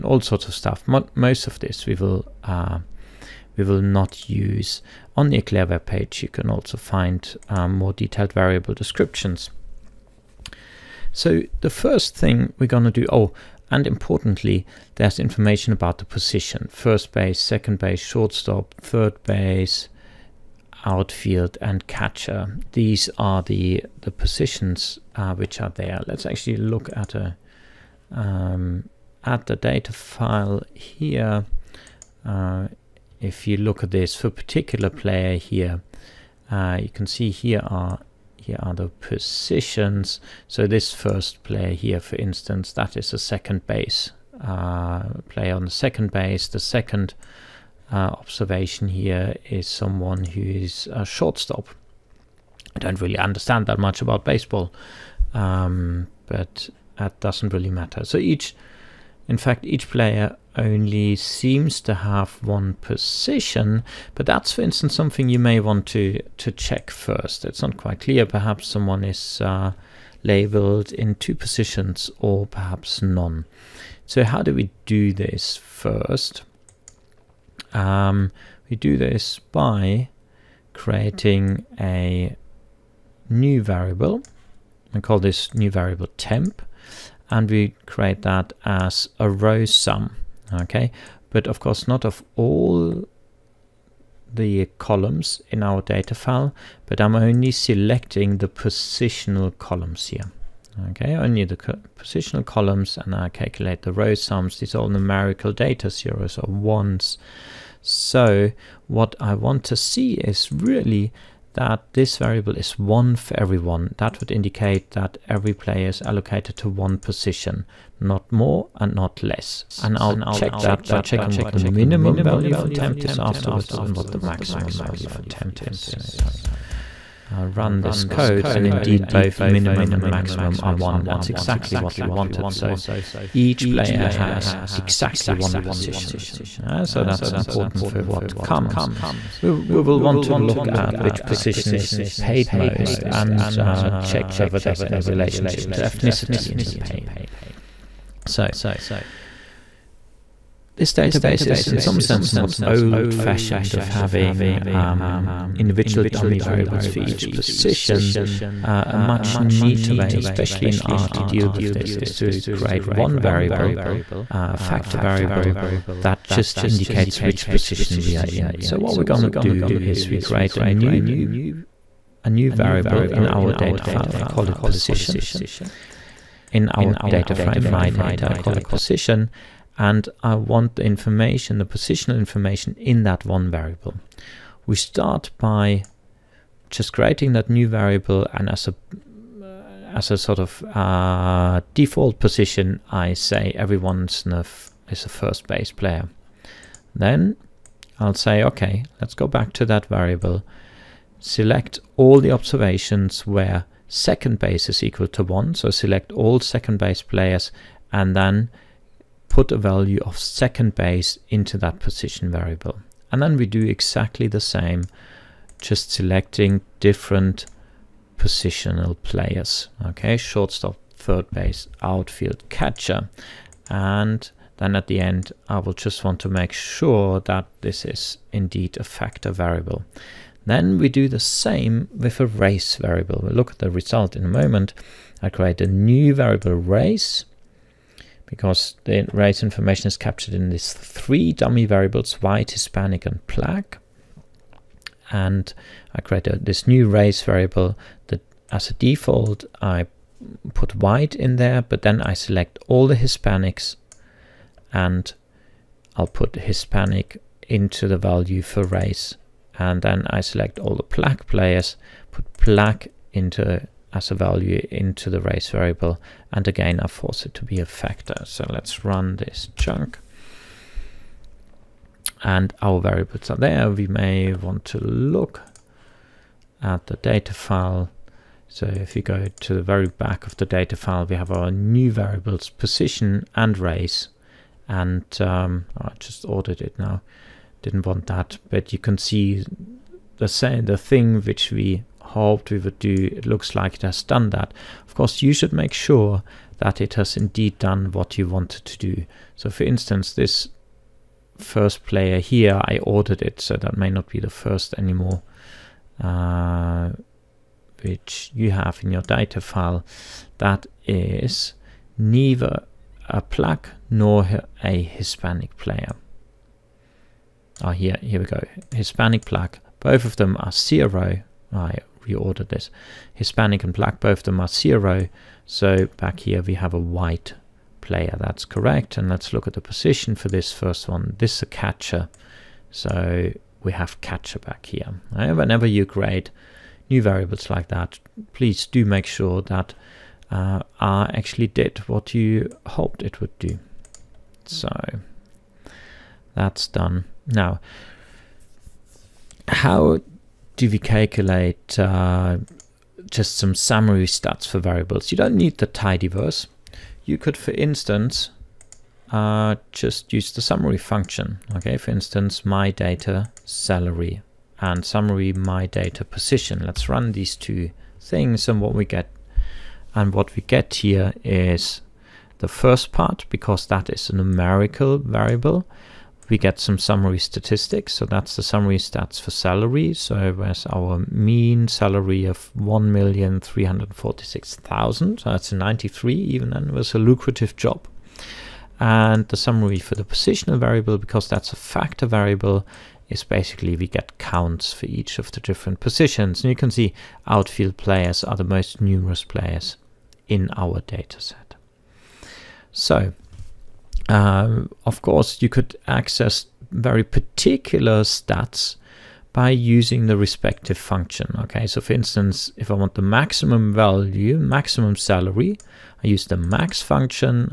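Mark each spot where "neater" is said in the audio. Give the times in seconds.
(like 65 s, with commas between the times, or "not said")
159 s.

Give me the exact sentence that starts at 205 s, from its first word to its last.
So select all second base players and then put a value of second base into that position variable.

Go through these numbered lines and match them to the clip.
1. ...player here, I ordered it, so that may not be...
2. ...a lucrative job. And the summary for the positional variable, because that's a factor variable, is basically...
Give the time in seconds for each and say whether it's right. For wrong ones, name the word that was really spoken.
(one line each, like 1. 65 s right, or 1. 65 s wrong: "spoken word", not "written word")
1. 301 s right
2. 386 s right.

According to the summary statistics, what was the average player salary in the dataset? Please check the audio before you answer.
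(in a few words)
1,346,000.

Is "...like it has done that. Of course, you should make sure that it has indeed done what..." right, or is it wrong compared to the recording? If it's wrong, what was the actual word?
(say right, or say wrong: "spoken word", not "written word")
right.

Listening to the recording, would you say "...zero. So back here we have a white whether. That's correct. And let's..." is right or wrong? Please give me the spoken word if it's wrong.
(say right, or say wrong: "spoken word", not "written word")
wrong: "player", not "whether".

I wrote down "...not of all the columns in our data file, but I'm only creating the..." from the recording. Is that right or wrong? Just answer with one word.
wrong.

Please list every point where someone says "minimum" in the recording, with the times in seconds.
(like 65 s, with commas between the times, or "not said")
121 s, 129 s.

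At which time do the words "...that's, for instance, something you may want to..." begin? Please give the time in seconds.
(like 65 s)
64 s.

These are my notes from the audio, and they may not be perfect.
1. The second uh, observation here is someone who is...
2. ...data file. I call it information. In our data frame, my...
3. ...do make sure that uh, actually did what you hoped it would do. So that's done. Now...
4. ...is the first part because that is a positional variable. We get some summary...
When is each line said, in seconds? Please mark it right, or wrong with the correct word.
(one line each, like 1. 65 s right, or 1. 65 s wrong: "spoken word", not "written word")
1. 46 s right
2. 173 s wrong: "position", not "information"
3. 338 s right
4. 371 s wrong: "numerical", not "positional".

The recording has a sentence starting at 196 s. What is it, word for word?
Then I'll say, okay, let's go back to that variable.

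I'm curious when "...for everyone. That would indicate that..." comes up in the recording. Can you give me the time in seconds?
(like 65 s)
113 s.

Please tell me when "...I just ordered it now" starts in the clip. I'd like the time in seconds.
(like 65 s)
285 s.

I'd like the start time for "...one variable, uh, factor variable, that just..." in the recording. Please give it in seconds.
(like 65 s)
162 s.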